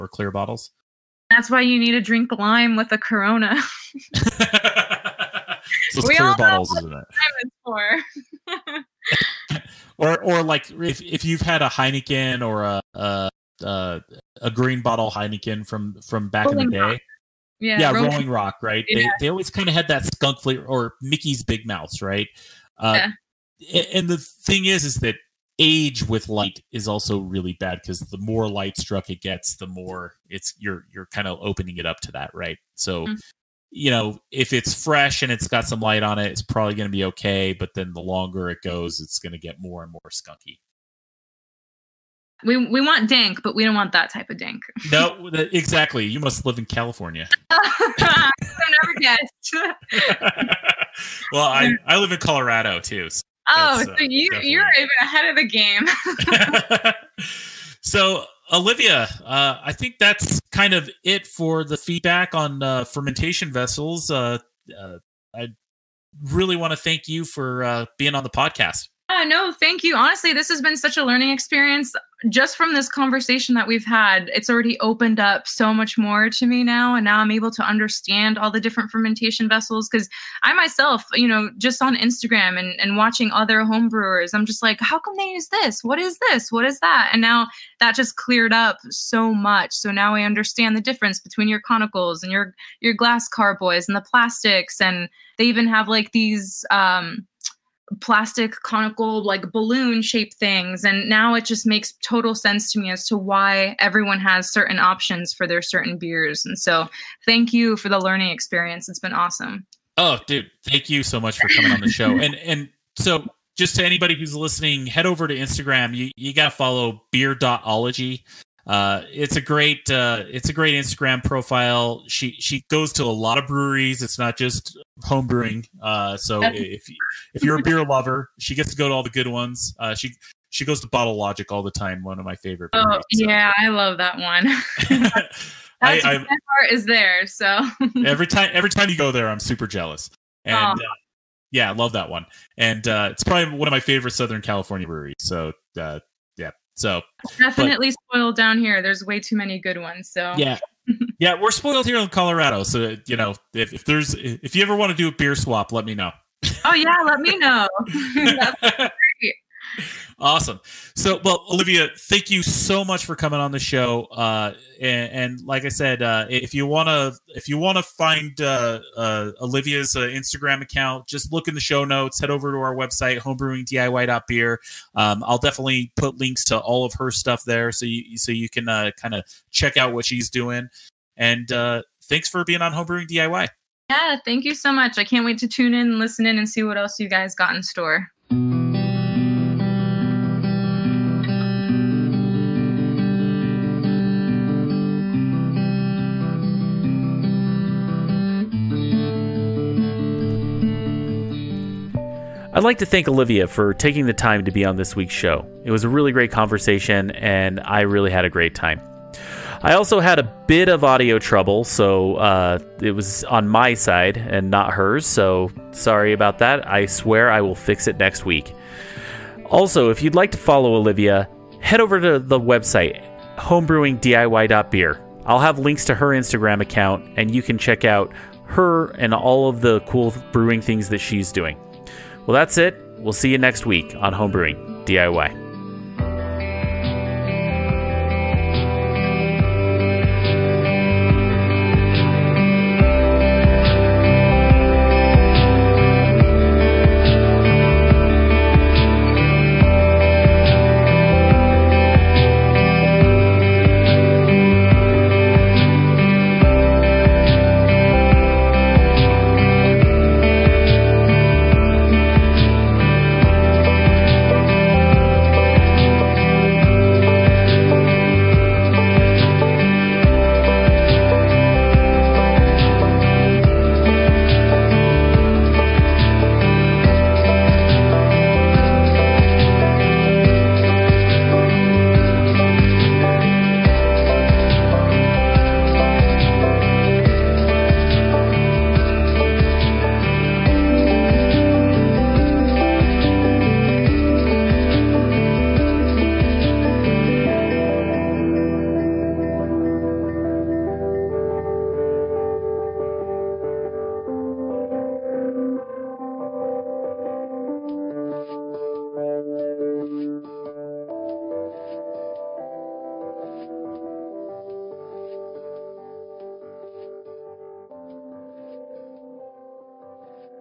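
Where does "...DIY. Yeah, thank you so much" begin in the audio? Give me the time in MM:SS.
03:03.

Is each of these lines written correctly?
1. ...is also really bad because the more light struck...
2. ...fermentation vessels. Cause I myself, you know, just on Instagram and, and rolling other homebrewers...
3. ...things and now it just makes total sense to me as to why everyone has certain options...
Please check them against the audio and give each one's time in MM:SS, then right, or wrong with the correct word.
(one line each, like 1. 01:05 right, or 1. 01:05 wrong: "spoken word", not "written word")
1. 00:26 right
2. 01:18 wrong: "watching", not "rolling"
3. 01:40 right.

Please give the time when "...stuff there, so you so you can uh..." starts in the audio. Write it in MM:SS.
02:57.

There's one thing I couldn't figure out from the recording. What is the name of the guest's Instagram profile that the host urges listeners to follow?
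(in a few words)
beer.ology.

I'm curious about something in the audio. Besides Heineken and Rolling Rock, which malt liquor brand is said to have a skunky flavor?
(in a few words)
Mickey's Big Mouth.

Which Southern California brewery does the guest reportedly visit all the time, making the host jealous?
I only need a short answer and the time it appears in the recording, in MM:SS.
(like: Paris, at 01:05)
Bottle Logic, at 02:10.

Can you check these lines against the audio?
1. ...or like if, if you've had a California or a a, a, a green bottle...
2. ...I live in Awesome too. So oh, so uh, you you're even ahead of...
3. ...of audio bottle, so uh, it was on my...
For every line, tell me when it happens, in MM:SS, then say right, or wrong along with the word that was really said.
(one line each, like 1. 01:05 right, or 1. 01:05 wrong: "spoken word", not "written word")
1. 00:10 wrong: "Heineken", not "California"
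2. 00:51 wrong: "Colorado", not "Awesome"
3. 03:30 wrong: "trouble", not "bottle".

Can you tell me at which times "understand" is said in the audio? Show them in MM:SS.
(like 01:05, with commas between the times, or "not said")
01:17, 01:30.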